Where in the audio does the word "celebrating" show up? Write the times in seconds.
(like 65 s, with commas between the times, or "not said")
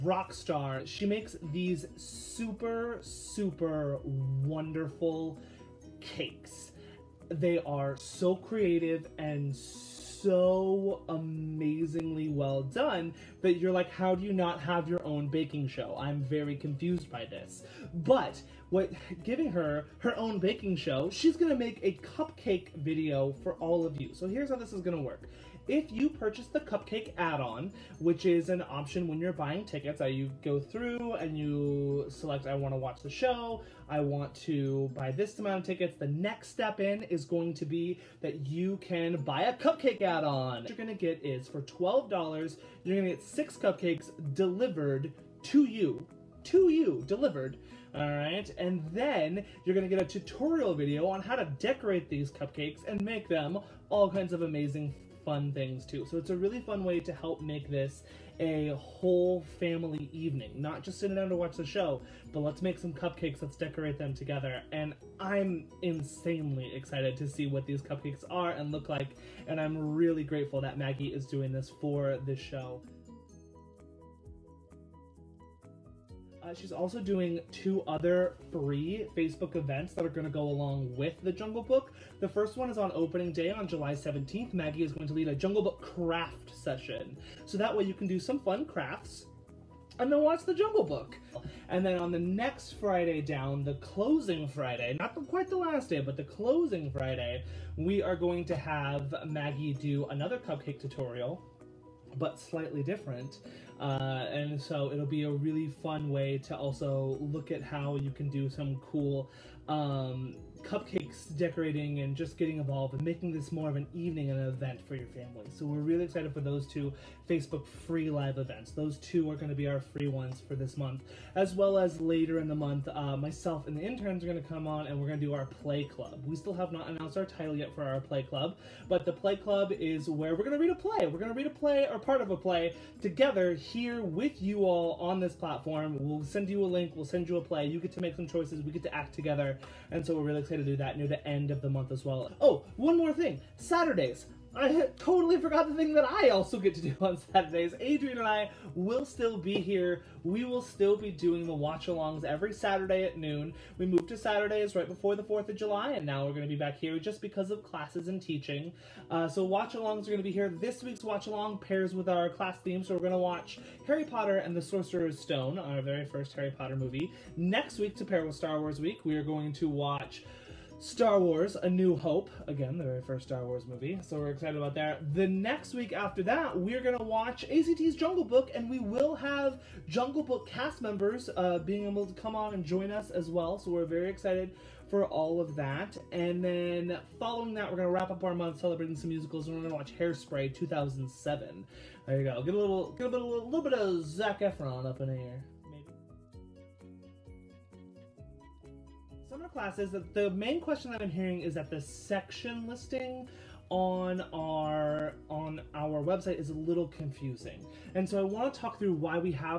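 188 s.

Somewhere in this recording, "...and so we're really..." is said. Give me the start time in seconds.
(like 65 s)
139 s.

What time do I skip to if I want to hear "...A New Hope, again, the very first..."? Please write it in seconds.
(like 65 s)
171 s.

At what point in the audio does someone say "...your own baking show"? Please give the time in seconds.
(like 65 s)
14 s.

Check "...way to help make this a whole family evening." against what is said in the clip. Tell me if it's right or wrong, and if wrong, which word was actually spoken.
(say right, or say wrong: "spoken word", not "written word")
right.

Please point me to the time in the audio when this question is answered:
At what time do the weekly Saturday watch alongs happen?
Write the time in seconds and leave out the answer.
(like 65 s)
153 s.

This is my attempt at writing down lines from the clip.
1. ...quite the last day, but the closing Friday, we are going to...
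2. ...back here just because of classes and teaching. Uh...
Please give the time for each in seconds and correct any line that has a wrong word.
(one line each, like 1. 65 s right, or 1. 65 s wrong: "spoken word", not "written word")
1. 95 s right
2. 156 s right.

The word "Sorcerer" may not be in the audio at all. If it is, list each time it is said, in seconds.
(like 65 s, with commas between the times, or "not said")
164 s.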